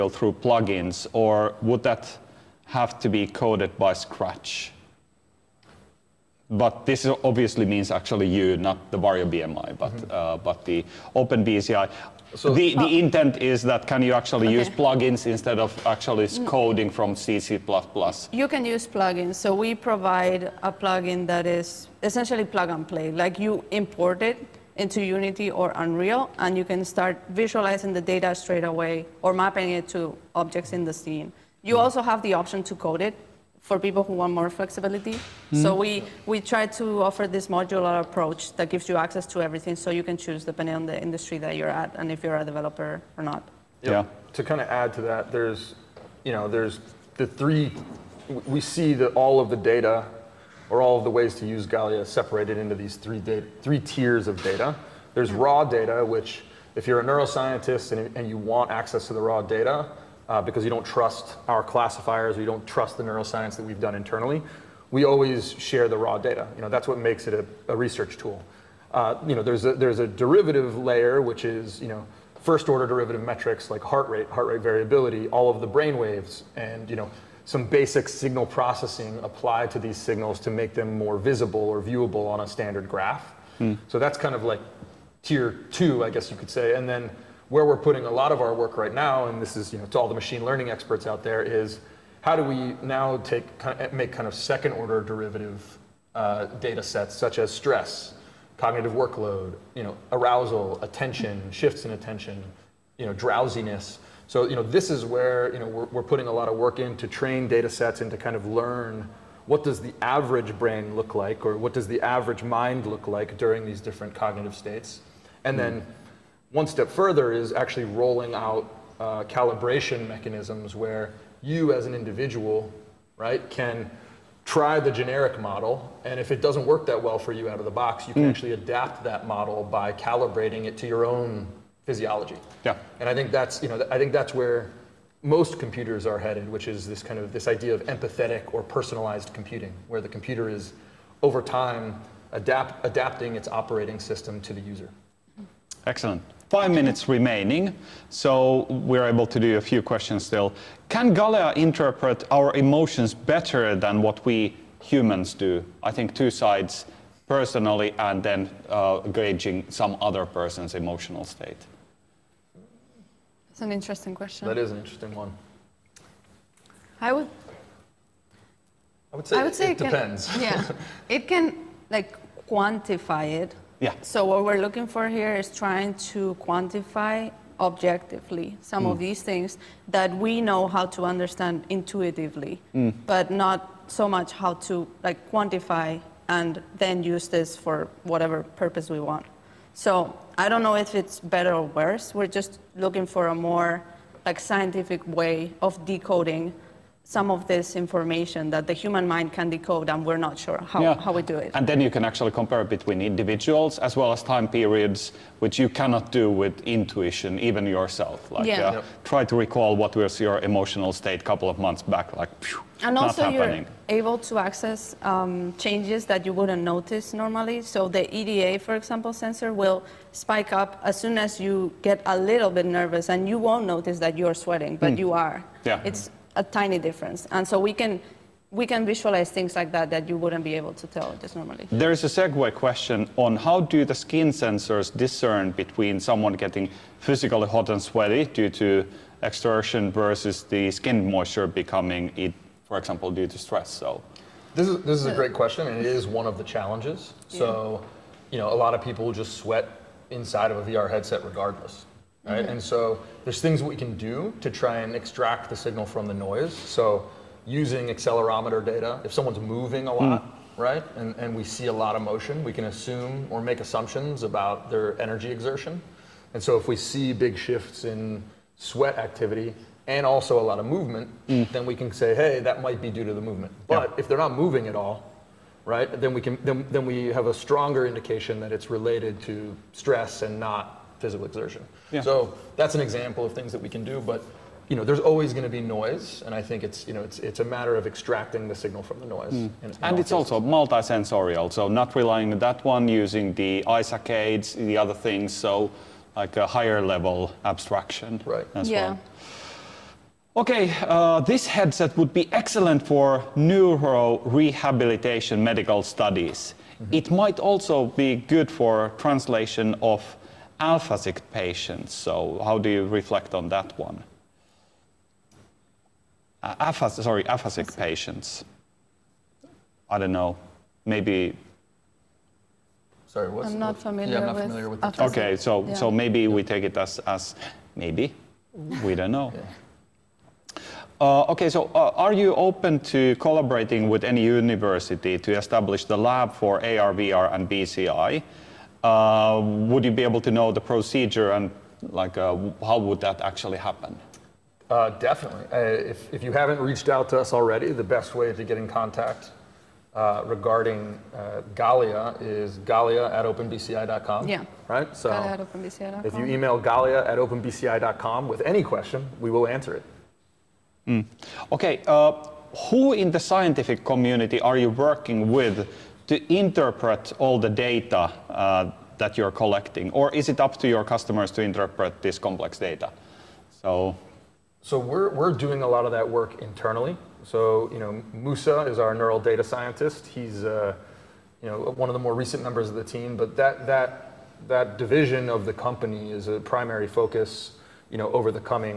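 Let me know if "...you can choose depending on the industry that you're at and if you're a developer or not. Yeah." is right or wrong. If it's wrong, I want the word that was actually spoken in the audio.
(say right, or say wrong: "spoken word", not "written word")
right.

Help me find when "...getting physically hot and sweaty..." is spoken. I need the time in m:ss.
3:56.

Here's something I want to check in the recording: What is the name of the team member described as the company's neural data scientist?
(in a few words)
Musa.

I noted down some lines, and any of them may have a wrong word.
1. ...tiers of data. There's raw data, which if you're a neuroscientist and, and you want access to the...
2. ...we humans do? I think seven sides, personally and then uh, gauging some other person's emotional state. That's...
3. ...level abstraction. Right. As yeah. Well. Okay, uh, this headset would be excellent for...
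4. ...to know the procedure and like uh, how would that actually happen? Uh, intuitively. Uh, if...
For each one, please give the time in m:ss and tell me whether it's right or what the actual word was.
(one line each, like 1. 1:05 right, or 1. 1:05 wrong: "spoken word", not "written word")
1. 0:53 right
2. 2:34 wrong: "two", not "seven"
3. 4:56 right
4. 5:40 wrong: "definitely", not "intuitively".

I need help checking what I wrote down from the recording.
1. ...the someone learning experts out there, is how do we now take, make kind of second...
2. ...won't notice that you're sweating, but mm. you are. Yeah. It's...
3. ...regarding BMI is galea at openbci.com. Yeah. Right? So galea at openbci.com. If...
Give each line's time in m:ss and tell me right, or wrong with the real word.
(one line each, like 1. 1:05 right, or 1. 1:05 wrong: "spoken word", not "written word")
1. 1:30 wrong: "machine", not "someone"
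2. 3:43 right
3. 5:50 wrong: "Galea", not "BMI".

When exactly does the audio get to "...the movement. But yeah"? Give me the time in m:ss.
4:33.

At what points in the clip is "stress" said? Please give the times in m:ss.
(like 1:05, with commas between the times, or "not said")
1:37, 4:03, 4:39.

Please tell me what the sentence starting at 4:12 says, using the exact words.
And so there's things we can do to try and extract the signal from the noise.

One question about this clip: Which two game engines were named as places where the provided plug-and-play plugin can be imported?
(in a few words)
Unity or Unreal.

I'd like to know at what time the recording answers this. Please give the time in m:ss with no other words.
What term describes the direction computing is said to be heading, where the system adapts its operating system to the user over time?
2:17.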